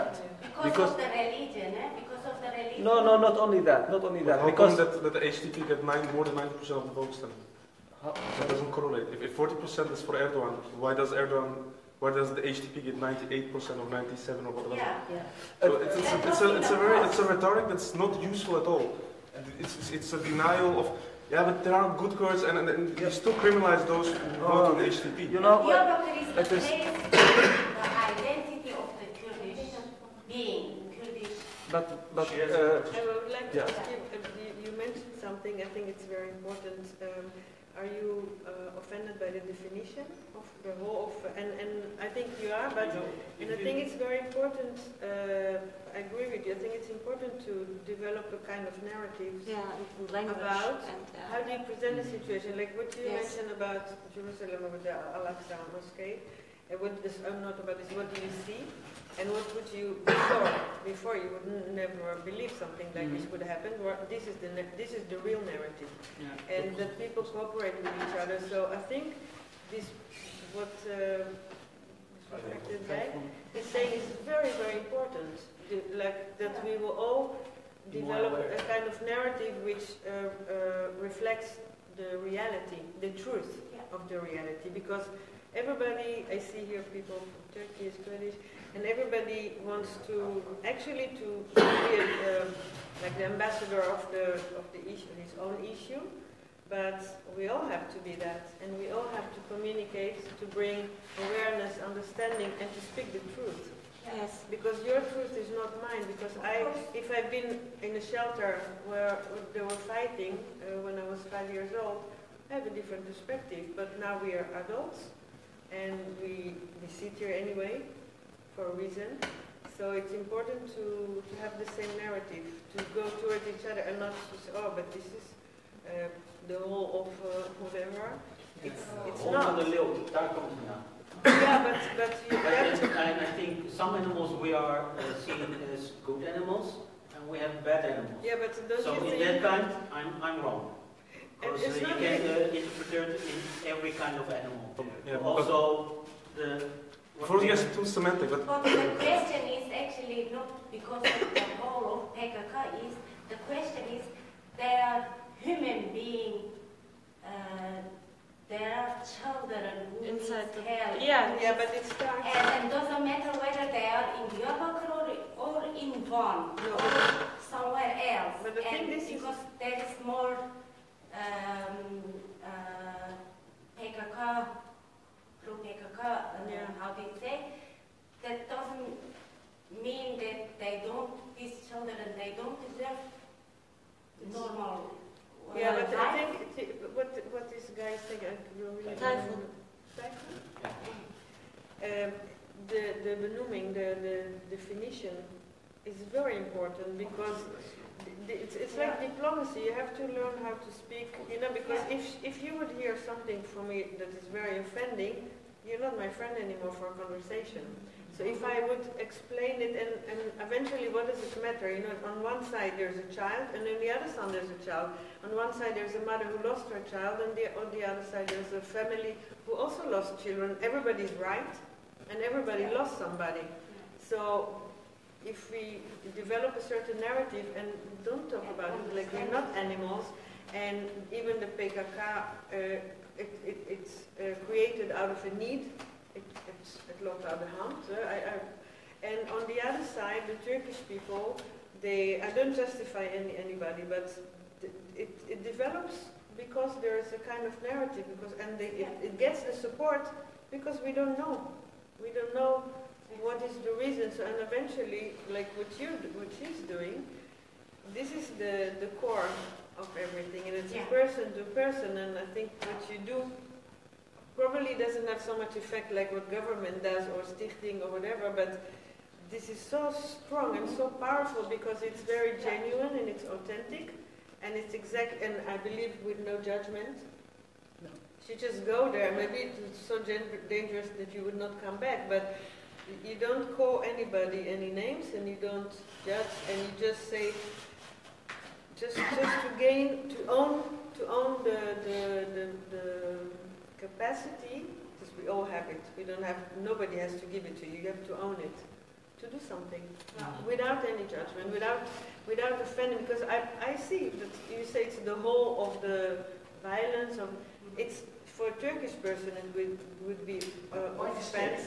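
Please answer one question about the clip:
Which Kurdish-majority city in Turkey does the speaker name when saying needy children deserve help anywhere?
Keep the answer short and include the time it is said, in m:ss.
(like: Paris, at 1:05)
Diyarbakir, at 2:44.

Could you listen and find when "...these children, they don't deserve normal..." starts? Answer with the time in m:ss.
3:01.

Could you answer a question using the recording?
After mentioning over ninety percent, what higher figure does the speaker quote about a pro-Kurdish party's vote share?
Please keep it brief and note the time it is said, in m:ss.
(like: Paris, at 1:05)
98%, at 0:12.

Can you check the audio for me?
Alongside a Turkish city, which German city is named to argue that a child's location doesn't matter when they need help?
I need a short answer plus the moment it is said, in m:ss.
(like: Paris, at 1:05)
Bonn, at 2:46.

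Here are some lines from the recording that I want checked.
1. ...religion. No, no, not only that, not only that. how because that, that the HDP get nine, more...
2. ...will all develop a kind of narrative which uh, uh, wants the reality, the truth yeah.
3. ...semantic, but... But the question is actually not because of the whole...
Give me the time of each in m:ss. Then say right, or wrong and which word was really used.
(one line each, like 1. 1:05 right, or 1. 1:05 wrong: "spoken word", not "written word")
1. 0:02 right
2. 1:16 wrong: "reflects", not "wants"
3. 2:27 right.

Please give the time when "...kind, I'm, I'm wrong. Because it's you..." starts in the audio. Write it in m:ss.
2:19.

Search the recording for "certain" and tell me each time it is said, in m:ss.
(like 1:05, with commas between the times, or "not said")
3:46.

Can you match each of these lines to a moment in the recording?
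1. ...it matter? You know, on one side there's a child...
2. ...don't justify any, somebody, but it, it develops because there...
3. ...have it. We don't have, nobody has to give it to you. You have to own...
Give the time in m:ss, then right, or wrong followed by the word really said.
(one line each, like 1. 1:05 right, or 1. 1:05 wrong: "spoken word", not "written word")
1. 3:31 right
2. 4:02 wrong: "anybody", not "somebody"
3. 4:55 right.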